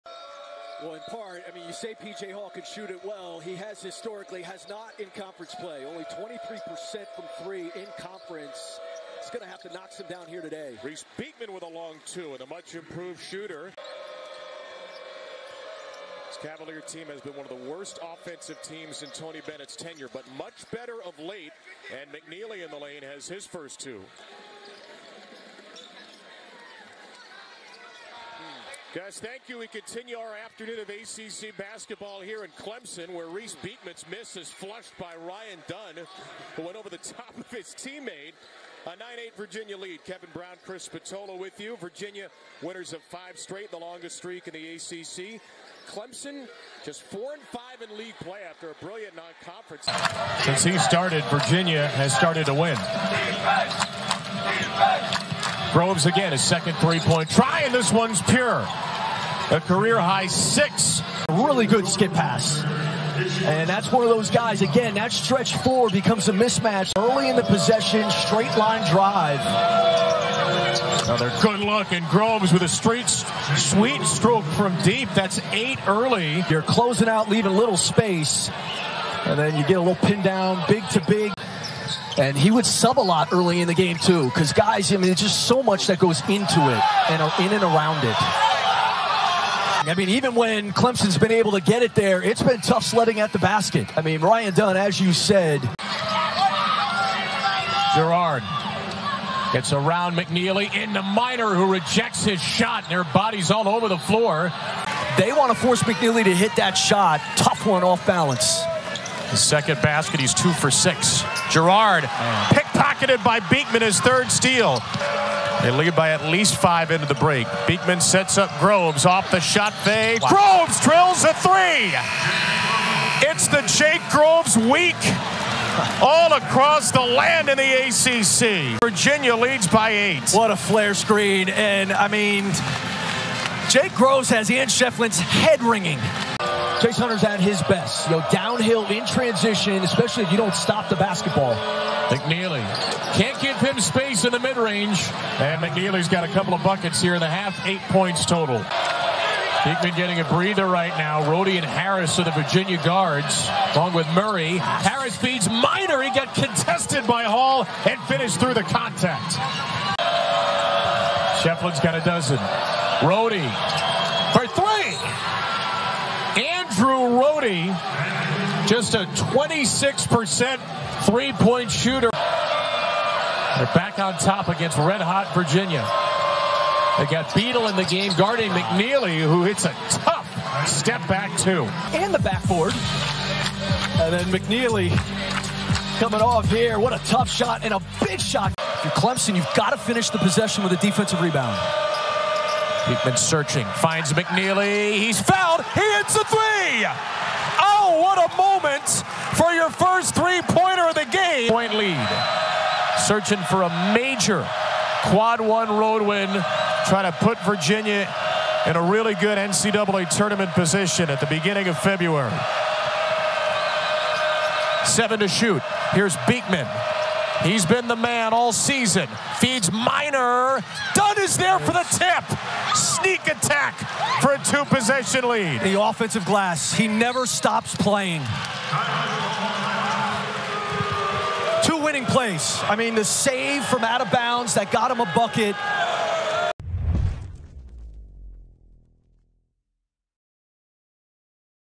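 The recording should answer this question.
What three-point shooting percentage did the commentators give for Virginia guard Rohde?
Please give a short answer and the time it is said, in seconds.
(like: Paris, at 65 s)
26%, at 169 s.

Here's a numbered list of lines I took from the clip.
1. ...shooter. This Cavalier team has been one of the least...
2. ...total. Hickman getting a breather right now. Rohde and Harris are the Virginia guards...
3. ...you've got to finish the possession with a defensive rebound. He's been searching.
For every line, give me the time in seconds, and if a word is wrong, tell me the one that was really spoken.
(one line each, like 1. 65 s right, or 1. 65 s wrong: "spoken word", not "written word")
1. 13 s wrong: "worst", not "least"
2. 148 s right
3. 189 s right.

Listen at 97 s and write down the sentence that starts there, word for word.
Girard gets around McKneely into Minor, who rejects his shot, and their bodies all over the floor.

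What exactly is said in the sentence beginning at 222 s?
Sneak attack for a two possession lead.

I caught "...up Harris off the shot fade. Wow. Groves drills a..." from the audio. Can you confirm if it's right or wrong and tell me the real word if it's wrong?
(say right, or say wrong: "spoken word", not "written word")
wrong: "Groves", not "Harris".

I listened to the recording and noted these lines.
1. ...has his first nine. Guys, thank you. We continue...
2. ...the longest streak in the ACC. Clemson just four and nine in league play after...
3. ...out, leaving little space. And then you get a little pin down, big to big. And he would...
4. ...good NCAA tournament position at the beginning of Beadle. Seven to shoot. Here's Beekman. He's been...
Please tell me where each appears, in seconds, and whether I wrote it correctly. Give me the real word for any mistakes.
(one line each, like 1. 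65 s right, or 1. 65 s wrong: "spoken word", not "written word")
1. 23 s wrong: "two", not "nine"
2. 43 s wrong: "five", not "nine"
3. 77 s right
4. 209 s wrong: "February", not "Beadle".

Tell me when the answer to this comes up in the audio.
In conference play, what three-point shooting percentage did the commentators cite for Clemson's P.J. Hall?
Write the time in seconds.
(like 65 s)
6 s.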